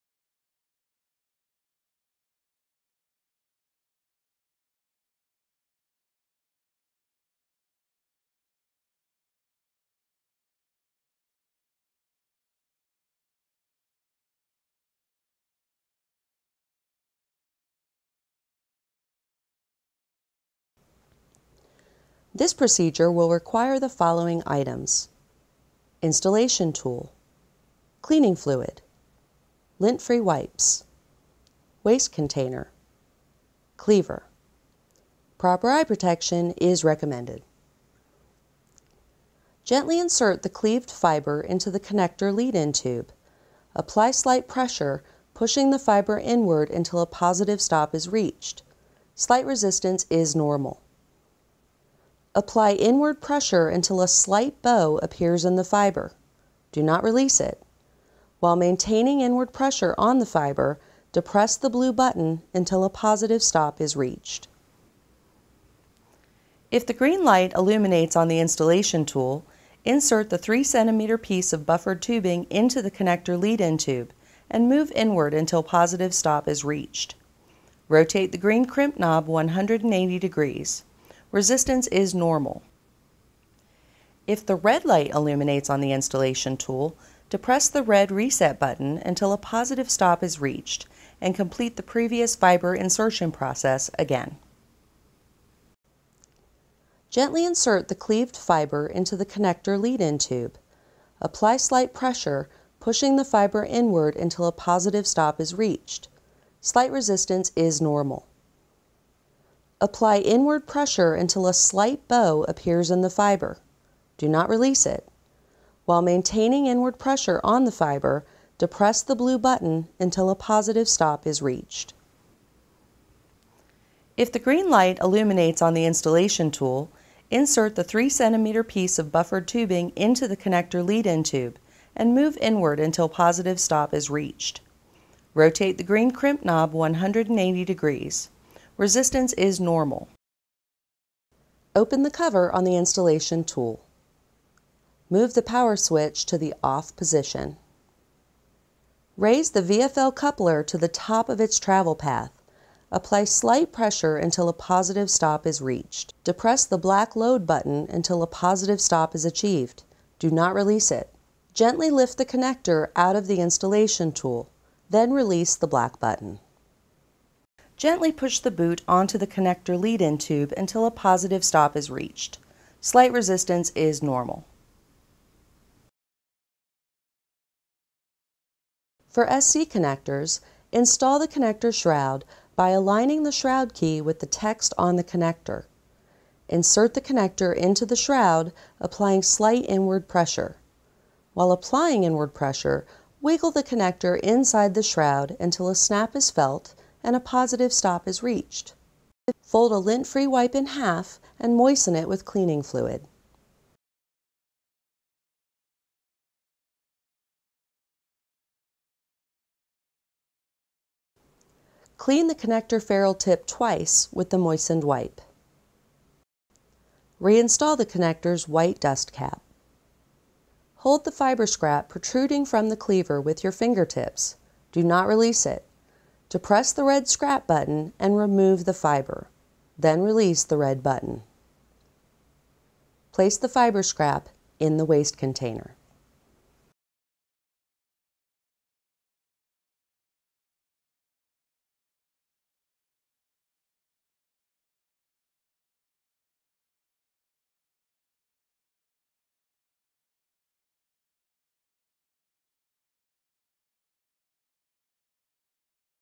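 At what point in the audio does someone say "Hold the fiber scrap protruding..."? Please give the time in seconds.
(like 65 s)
220 s.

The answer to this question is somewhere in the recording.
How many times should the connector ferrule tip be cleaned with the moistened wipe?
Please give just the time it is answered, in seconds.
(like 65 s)
213 s.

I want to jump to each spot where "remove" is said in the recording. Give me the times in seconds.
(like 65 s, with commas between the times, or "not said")
228 s.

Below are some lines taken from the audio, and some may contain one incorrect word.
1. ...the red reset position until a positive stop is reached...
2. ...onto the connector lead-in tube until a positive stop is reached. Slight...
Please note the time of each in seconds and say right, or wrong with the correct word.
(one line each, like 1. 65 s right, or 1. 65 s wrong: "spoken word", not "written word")
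1. 87 s wrong: "button", not "position"
2. 168 s right.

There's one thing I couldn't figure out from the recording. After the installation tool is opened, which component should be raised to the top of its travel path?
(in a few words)
VFL coupler.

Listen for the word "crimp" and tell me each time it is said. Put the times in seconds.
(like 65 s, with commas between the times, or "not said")
78 s, 136 s.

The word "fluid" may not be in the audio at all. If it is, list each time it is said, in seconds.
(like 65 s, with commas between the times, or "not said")
28 s, 202 s.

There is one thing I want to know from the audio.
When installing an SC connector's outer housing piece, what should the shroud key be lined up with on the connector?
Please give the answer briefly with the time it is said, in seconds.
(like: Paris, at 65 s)
the text, at 184 s.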